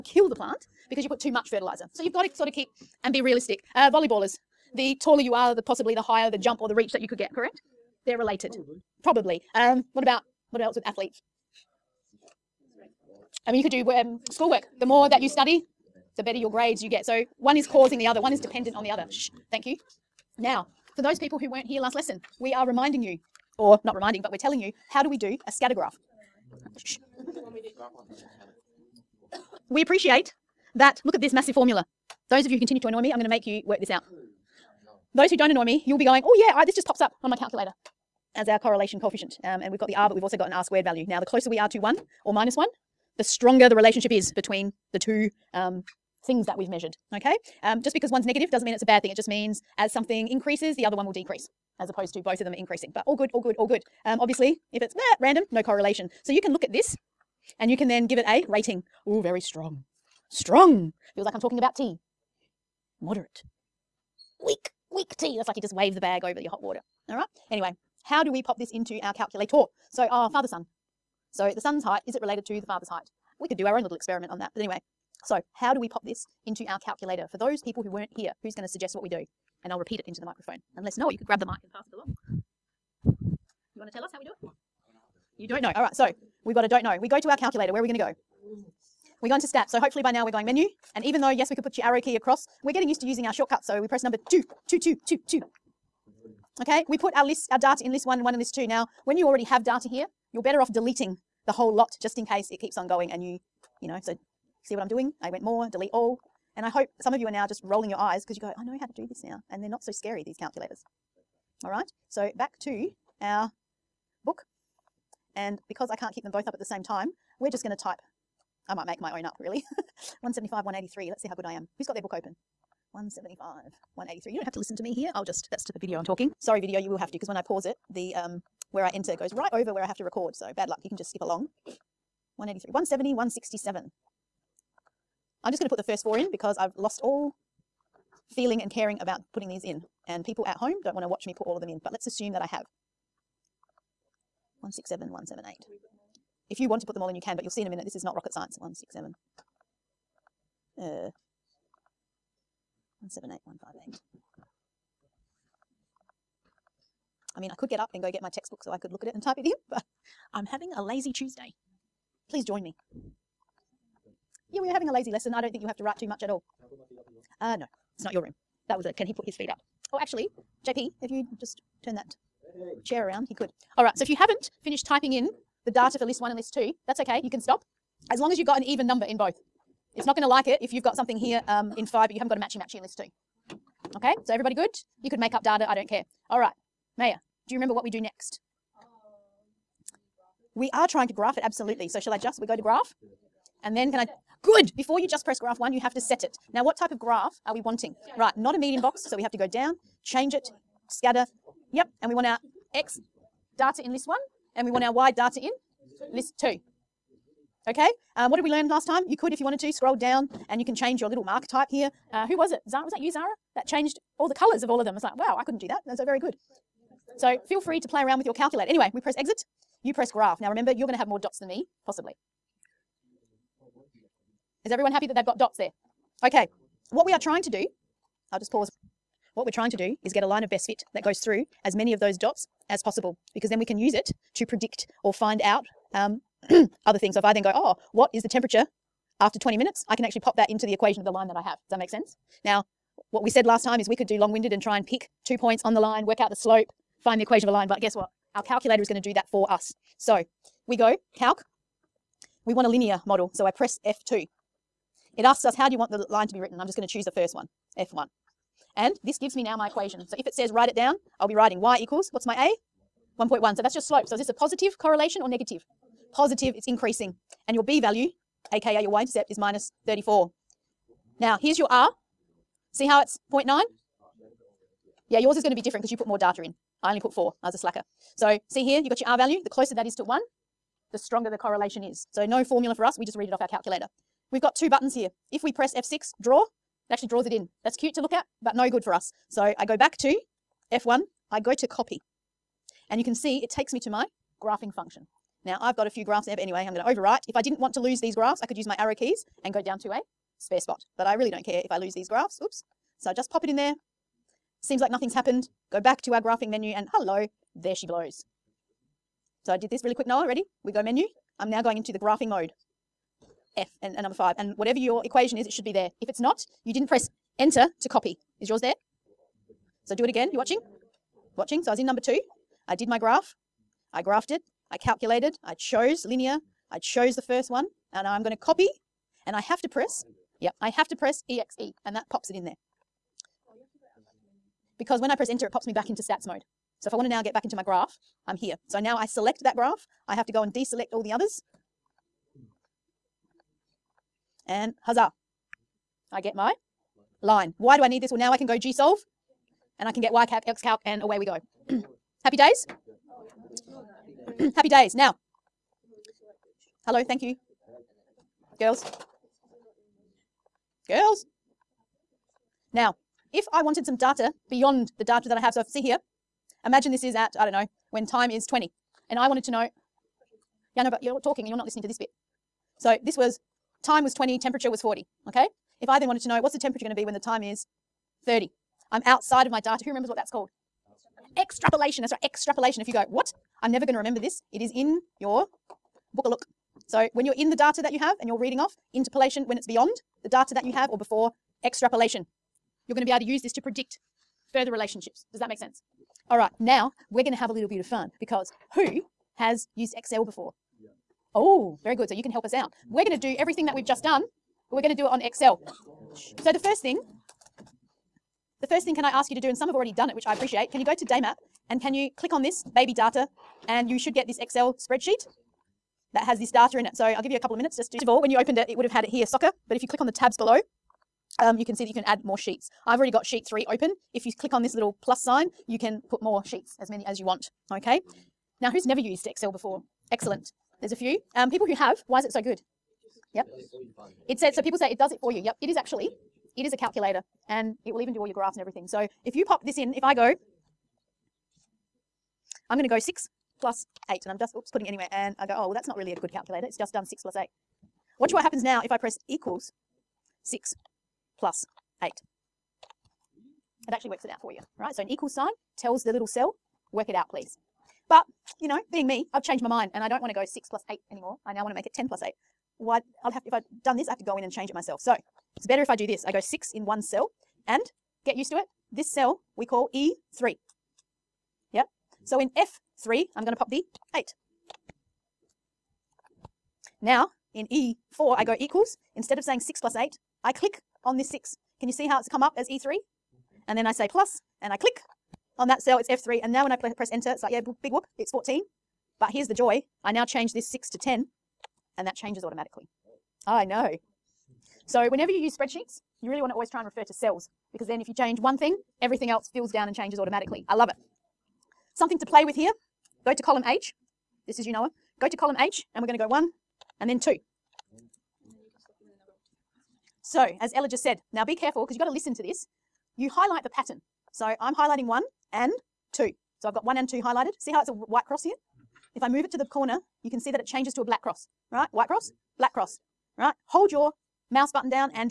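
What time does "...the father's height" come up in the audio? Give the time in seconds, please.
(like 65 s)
72 s.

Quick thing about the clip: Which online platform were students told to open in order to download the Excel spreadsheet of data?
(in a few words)
Daymap.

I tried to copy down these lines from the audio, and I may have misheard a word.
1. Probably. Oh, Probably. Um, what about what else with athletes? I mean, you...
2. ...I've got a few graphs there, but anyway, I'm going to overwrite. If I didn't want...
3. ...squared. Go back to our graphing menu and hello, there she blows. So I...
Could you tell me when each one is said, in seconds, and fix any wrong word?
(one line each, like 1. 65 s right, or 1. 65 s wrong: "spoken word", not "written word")
1. 8 s right
2. 295 s right
3. 305 s wrong: "happened", not "squared".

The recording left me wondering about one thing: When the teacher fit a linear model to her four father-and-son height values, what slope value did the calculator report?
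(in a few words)
1.1.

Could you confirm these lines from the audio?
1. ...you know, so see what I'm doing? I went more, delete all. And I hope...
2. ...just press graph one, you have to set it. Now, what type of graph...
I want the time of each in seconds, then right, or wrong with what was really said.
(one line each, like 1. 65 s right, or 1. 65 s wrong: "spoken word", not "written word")
1. 103 s right
2. 195 s right.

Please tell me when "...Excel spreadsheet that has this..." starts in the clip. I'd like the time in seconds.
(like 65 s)
414 s.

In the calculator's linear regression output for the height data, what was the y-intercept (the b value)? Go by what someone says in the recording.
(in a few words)
-34.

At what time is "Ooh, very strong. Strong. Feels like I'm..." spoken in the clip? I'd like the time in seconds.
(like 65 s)
59 s.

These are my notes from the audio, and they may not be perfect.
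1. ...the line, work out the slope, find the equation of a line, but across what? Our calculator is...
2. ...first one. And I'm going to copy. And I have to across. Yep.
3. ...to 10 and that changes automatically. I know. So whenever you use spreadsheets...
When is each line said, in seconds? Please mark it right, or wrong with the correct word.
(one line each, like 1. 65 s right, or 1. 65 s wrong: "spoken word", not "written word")
1. 245 s wrong: "guess", not "across"
2. 327 s wrong: "press", not "across"
3. 490 s right.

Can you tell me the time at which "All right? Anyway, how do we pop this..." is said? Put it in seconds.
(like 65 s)
67 s.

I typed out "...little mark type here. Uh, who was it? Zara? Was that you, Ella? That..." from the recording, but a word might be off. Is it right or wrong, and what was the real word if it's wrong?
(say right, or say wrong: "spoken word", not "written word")
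wrong: "Zara", not "Ella".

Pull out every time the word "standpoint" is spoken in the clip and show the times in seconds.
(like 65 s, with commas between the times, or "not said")
not said.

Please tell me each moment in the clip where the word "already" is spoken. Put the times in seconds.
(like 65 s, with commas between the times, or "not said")
99 s, 409 s, 422 s.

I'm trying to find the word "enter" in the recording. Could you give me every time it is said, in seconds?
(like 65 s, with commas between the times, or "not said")
128 s, 317 s, 335 s, 487 s.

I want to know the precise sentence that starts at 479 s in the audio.
Instead of saying 6 plus 8, I click on this 6.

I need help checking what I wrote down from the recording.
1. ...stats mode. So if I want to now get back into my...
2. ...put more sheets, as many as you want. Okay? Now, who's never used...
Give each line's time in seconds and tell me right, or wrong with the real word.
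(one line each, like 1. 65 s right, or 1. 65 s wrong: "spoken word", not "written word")
1. 336 s right
2. 426 s right.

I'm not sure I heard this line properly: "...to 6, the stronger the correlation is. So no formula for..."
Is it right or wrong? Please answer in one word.
wrong.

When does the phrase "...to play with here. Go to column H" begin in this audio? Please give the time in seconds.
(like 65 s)
502 s.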